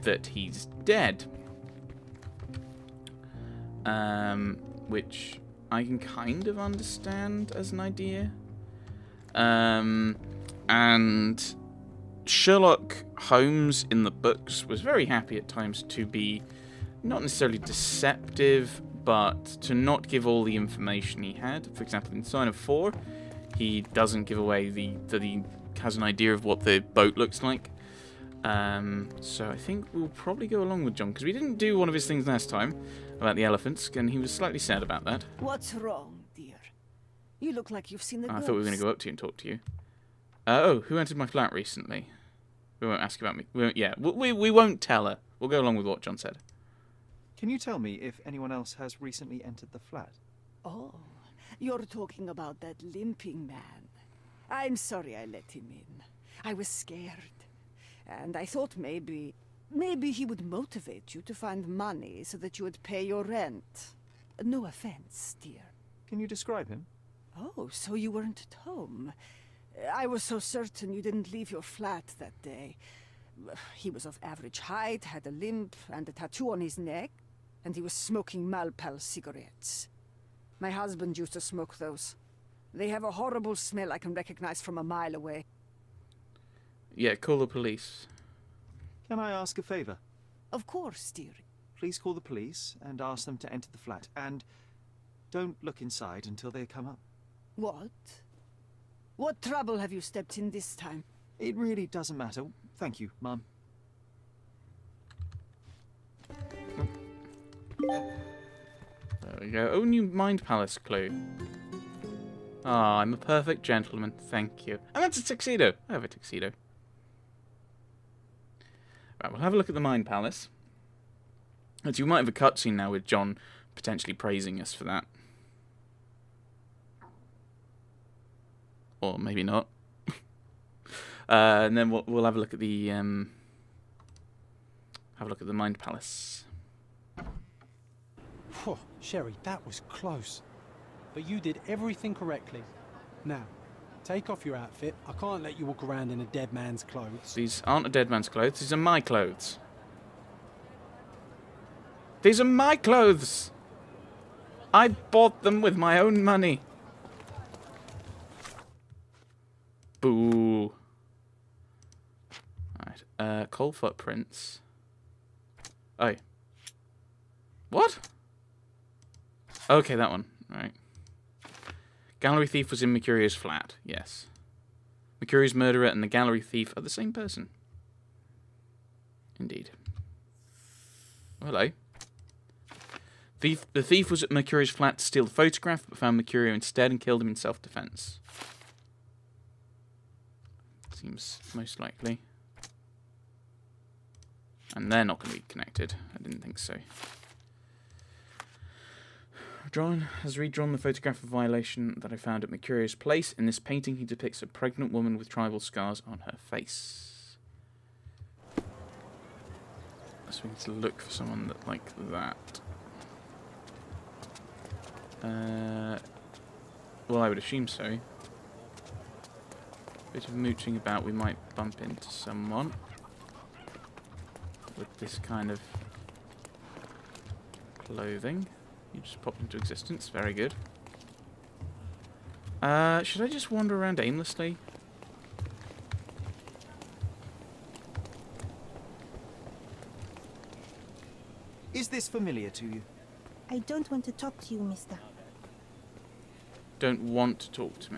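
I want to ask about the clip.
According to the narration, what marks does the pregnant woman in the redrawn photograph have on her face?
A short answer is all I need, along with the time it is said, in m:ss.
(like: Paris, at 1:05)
Tribal scars, at 3:25.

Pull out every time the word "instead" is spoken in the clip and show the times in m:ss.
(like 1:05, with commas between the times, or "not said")
3:06.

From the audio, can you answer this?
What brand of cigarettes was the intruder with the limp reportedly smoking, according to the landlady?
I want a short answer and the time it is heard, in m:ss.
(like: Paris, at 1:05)
Malpal, at 1:18.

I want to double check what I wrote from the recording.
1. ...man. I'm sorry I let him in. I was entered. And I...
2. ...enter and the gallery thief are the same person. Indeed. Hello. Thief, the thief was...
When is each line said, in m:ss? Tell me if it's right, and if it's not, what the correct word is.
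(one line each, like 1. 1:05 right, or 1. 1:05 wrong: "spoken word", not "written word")
1. 0:53 wrong: "scared", not "entered"
2. 2:55 wrong: "murderer", not "enter".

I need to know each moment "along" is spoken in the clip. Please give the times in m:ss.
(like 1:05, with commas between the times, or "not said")
0:30, 0:45.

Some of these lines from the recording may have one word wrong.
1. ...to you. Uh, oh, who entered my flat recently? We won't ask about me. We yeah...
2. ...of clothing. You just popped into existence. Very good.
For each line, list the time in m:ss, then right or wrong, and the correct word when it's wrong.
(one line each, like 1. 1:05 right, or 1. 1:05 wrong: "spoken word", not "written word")
1. 0:39 right
2. 3:45 right.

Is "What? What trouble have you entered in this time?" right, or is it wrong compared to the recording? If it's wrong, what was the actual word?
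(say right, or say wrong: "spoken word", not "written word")
wrong: "stepped", not "entered".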